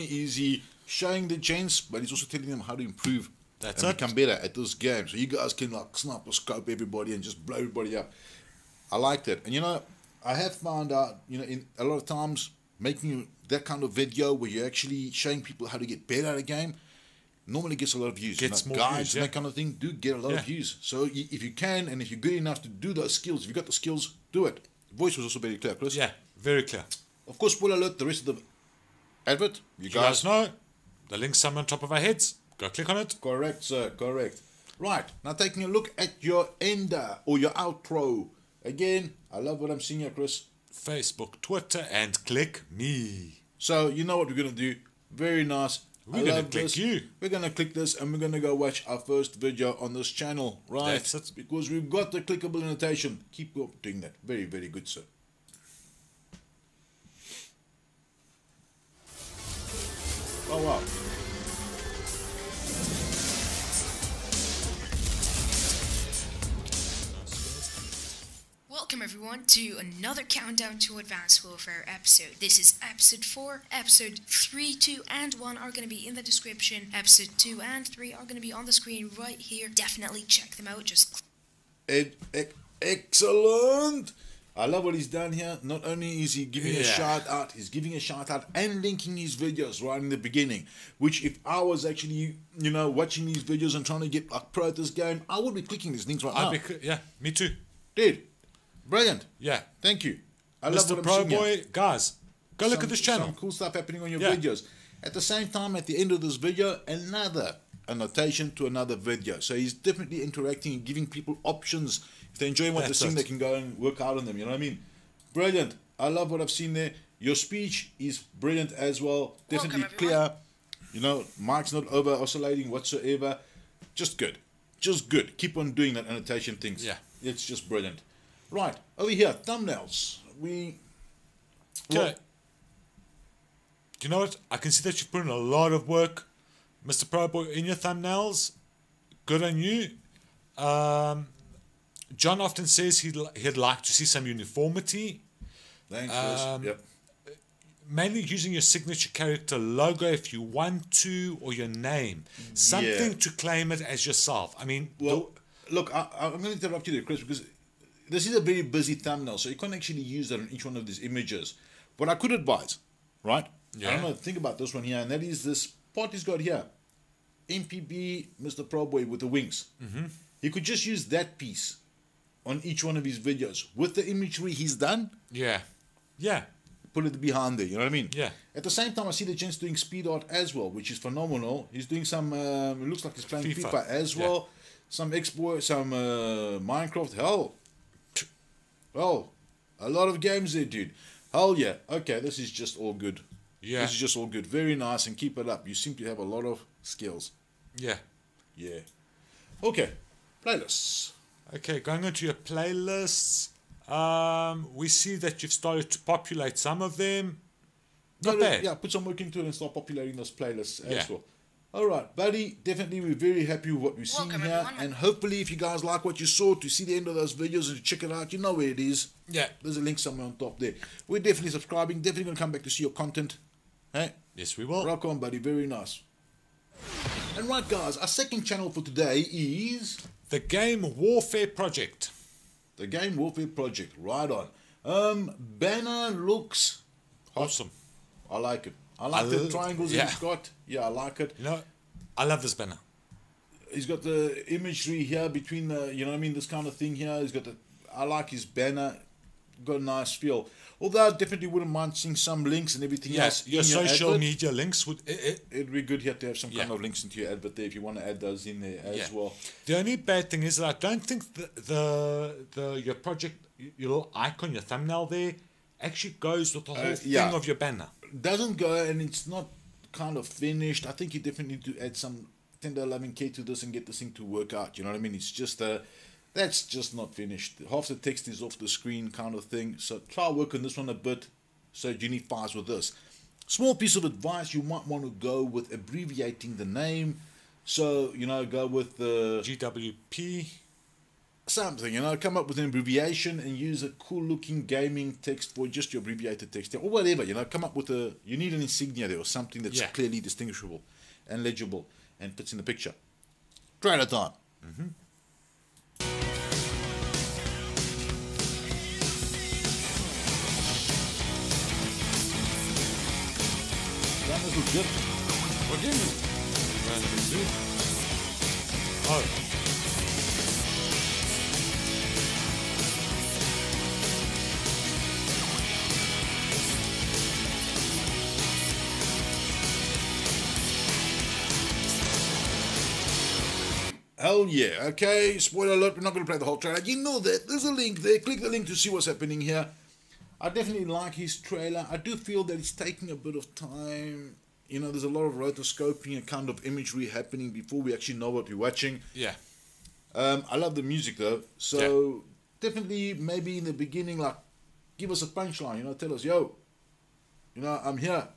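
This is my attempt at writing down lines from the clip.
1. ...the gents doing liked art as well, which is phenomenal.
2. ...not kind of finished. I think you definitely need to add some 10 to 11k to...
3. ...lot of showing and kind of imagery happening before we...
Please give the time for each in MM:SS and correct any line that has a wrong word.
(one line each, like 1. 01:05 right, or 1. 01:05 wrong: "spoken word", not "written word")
1. 02:59 wrong: "speed", not "liked"
2. 04:29 right
3. 05:45 wrong: "rotoscoping", not "showing".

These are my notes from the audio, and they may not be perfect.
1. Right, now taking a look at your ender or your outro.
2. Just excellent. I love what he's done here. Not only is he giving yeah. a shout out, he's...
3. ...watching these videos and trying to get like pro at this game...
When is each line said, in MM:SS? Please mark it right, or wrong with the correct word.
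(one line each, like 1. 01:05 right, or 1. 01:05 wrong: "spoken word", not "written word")
1. 00:34 right
2. 01:20 right
3. 01:32 right.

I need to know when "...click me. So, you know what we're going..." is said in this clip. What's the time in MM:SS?
00:42.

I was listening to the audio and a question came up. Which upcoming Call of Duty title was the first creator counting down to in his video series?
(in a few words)
Advanced Warfare.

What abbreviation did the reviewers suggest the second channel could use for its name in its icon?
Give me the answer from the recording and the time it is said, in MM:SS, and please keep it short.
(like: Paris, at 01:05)
GWP, at 04:49.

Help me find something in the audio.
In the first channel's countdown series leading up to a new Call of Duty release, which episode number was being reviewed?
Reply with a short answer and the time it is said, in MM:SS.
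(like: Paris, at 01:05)
4, at 01:12.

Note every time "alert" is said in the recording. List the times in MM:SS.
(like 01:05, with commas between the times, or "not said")
00:27, 05:35.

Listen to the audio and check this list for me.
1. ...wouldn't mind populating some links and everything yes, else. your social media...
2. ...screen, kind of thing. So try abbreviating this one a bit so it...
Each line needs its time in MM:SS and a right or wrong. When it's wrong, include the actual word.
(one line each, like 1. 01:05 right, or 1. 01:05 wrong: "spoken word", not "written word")
1. 04:11 wrong: "seeing", not "populating"
2. 04:38 wrong: "working", not "abbreviating".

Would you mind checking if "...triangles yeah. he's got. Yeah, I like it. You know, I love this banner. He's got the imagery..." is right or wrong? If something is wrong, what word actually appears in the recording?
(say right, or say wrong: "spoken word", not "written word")
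right.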